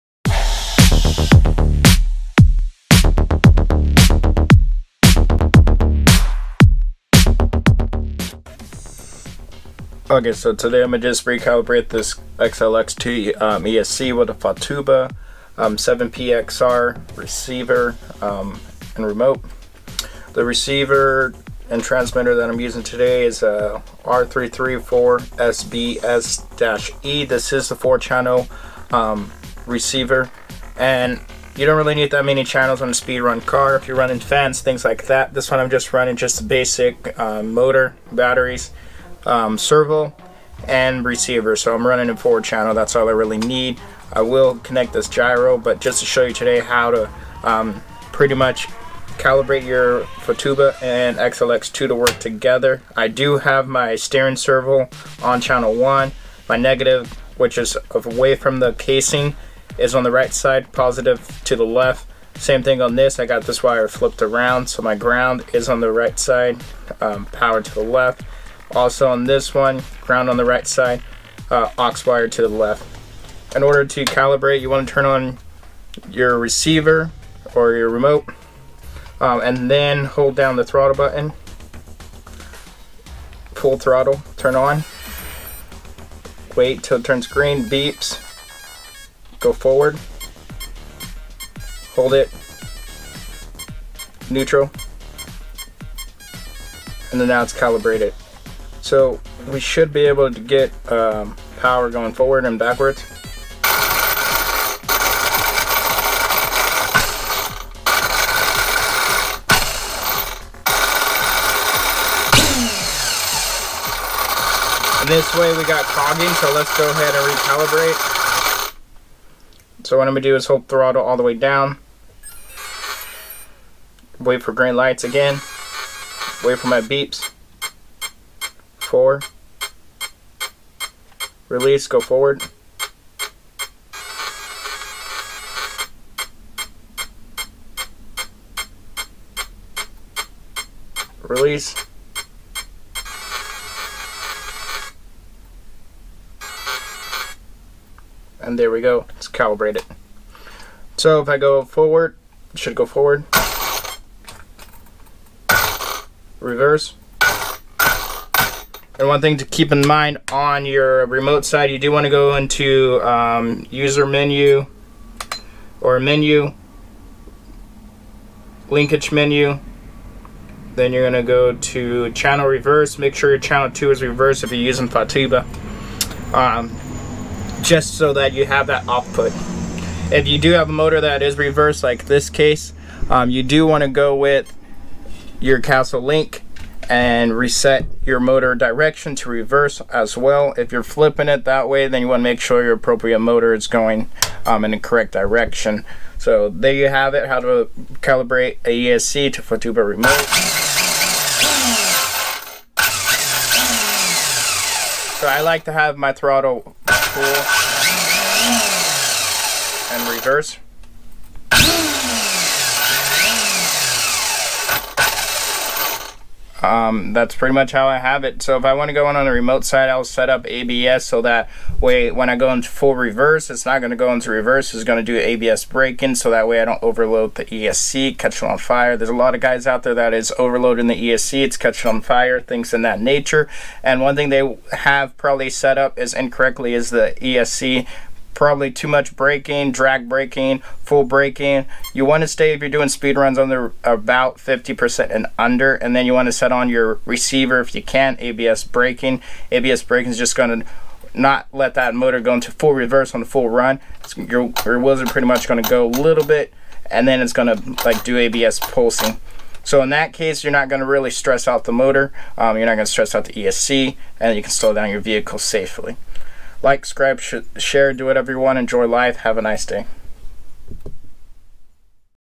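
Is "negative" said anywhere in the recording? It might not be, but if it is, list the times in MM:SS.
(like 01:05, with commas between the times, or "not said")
00:56.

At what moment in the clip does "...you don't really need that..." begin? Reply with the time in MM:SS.
00:31.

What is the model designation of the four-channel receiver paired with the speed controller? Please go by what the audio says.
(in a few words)
R334SBS-E.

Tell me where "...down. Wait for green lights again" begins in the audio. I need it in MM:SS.
02:01.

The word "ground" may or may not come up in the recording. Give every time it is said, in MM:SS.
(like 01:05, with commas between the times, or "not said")
01:04, 01:10.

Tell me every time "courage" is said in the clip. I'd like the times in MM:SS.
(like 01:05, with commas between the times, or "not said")
not said.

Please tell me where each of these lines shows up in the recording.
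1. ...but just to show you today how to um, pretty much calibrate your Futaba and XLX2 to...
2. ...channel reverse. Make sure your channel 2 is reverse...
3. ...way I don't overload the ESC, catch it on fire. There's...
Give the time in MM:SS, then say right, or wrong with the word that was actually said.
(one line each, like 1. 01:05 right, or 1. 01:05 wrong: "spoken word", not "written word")
1. 00:45 right
2. 02:52 right
3. 03:46 right.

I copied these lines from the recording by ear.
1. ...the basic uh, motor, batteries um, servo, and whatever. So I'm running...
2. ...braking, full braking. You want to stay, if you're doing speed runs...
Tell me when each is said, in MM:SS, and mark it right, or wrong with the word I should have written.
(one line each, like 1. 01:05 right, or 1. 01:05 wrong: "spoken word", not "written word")
1. 00:36 wrong: "receiver", not "whatever"
2. 04:00 right.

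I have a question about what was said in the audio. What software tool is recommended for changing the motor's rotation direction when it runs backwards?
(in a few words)
Castle Link.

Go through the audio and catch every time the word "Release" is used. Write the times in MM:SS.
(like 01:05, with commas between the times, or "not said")
02:11, 02:21.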